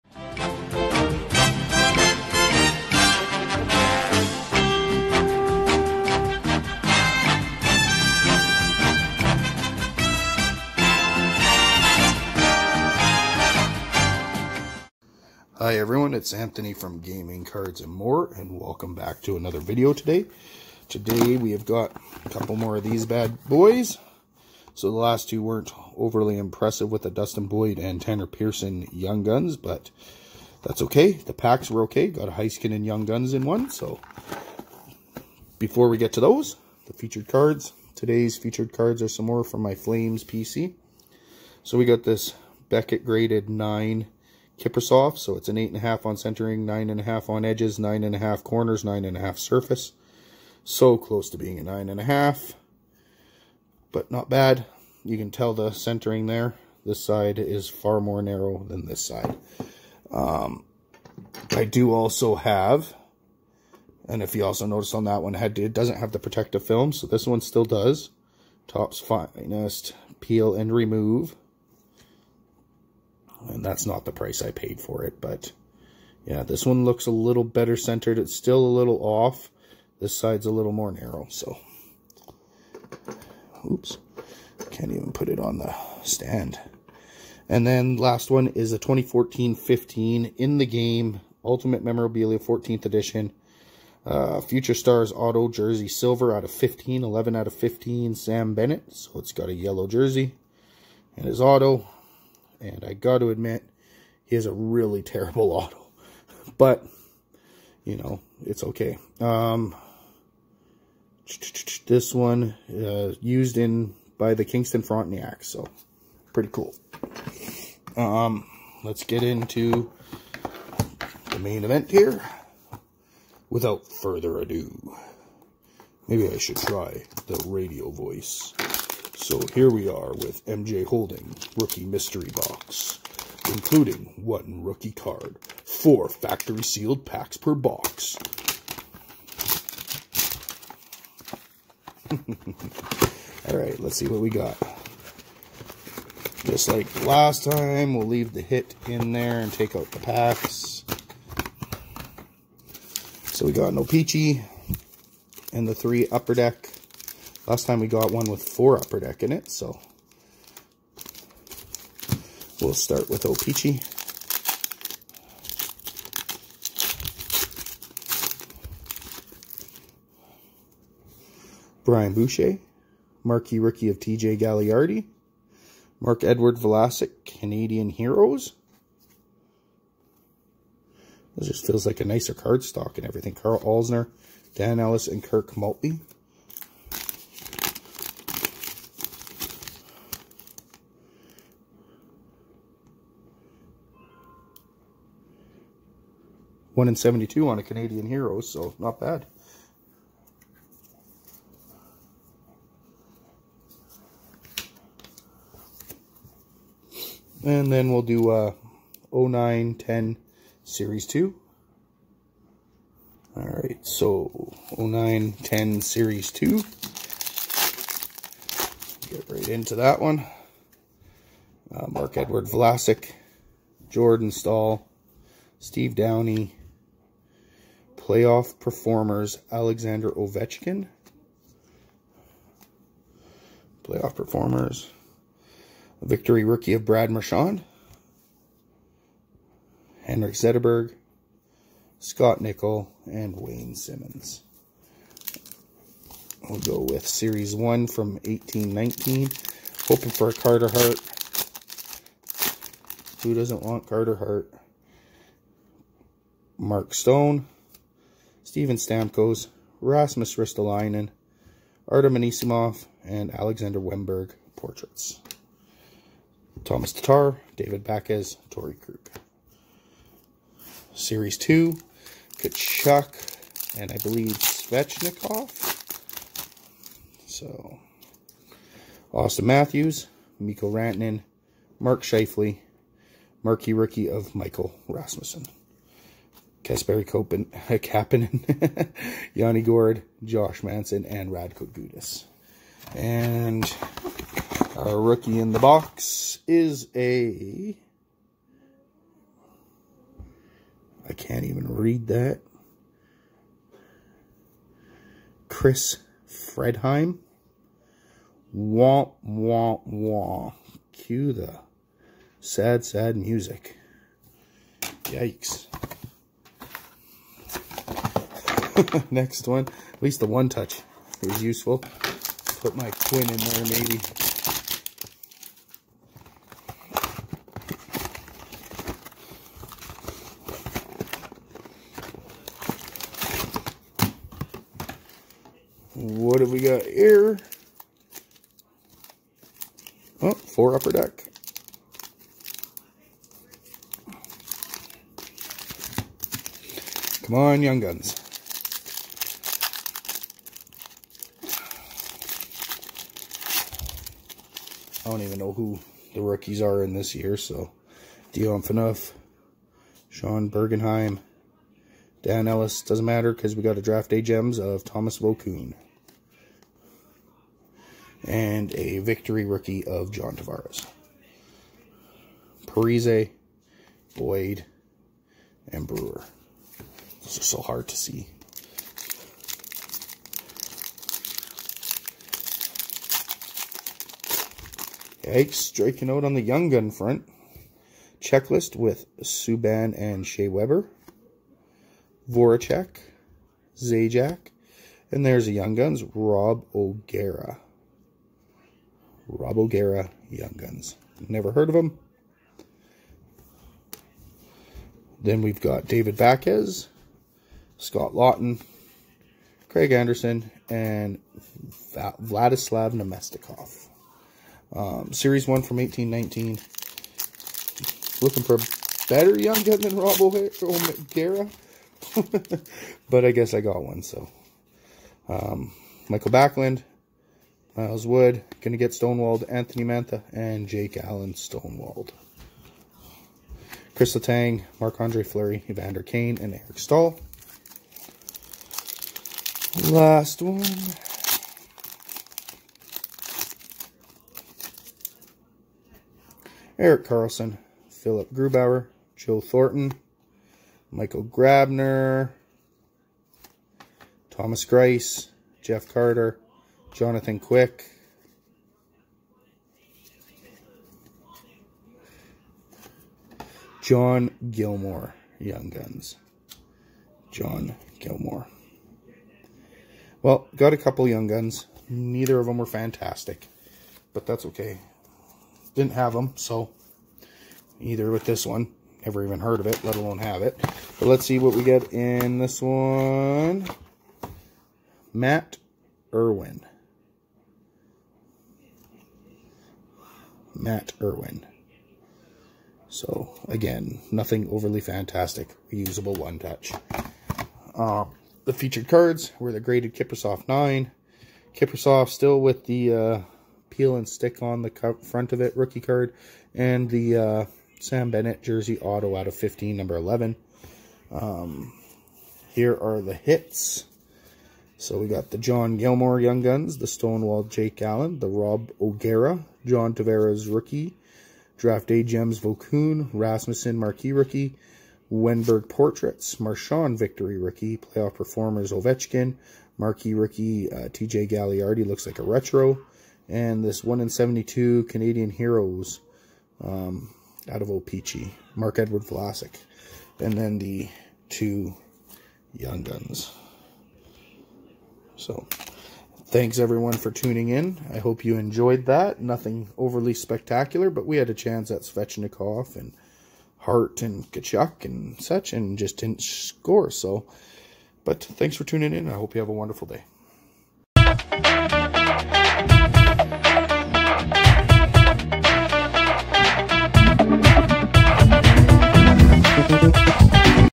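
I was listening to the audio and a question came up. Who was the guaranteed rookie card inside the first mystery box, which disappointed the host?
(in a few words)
Chris Fredheim.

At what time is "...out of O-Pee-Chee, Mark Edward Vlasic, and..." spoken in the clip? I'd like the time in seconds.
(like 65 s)
537 s.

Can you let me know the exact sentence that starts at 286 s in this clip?
Kasperi Kopen, Kapanen, Yanni Gourde, Josh Manson, and Radko Gudas.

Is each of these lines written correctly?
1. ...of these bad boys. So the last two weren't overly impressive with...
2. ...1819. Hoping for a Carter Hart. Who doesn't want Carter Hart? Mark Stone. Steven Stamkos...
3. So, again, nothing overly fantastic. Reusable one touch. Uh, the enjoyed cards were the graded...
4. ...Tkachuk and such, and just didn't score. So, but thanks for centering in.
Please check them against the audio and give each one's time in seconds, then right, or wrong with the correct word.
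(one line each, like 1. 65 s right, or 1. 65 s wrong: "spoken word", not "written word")
1. 22 s right
2. 248 s right
3. 492 s wrong: "featured", not "enjoyed"
4. 554 s wrong: "tuning", not "centering".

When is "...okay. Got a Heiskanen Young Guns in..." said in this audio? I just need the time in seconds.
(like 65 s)
31 s.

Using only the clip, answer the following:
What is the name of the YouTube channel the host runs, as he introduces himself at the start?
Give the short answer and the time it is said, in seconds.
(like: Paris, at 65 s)
Gaming Cards and More, at 16 s.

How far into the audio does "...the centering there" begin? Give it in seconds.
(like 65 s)
55 s.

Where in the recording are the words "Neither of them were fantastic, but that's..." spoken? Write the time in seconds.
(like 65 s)
471 s.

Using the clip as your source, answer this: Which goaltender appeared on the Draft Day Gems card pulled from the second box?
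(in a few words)
Thomas Vokoun.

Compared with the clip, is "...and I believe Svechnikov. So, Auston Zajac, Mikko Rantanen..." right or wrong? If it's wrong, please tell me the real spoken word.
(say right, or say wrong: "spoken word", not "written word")
wrong: "Matthews", not "Zajac".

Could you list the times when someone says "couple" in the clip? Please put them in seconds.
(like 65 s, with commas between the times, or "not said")
22 s, 470 s.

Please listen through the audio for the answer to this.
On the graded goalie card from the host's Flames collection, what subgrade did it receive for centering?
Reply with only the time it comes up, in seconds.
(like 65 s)
45 s.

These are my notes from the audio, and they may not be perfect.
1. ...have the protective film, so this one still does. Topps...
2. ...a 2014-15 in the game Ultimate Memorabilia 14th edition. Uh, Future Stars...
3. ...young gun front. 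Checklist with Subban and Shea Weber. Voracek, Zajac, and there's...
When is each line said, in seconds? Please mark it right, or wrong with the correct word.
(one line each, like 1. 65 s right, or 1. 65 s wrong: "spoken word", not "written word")
1. 65 s right
2. 88 s right
3. 386 s right.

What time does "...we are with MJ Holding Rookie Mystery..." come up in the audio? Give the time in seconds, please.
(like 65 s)
129 s.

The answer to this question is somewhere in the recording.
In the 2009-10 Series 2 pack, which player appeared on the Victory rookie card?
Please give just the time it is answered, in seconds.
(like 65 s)
236 s.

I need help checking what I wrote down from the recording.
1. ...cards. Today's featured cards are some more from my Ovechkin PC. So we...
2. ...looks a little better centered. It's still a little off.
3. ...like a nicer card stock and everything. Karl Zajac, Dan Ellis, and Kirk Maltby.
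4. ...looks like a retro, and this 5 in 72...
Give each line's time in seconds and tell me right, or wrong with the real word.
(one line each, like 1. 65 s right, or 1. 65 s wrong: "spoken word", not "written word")
1. 37 s wrong: "Flames", not "Ovechkin"
2. 76 s right
3. 181 s wrong: "Alzner", not "Zajac"
4. 531 s wrong: "1", not "5".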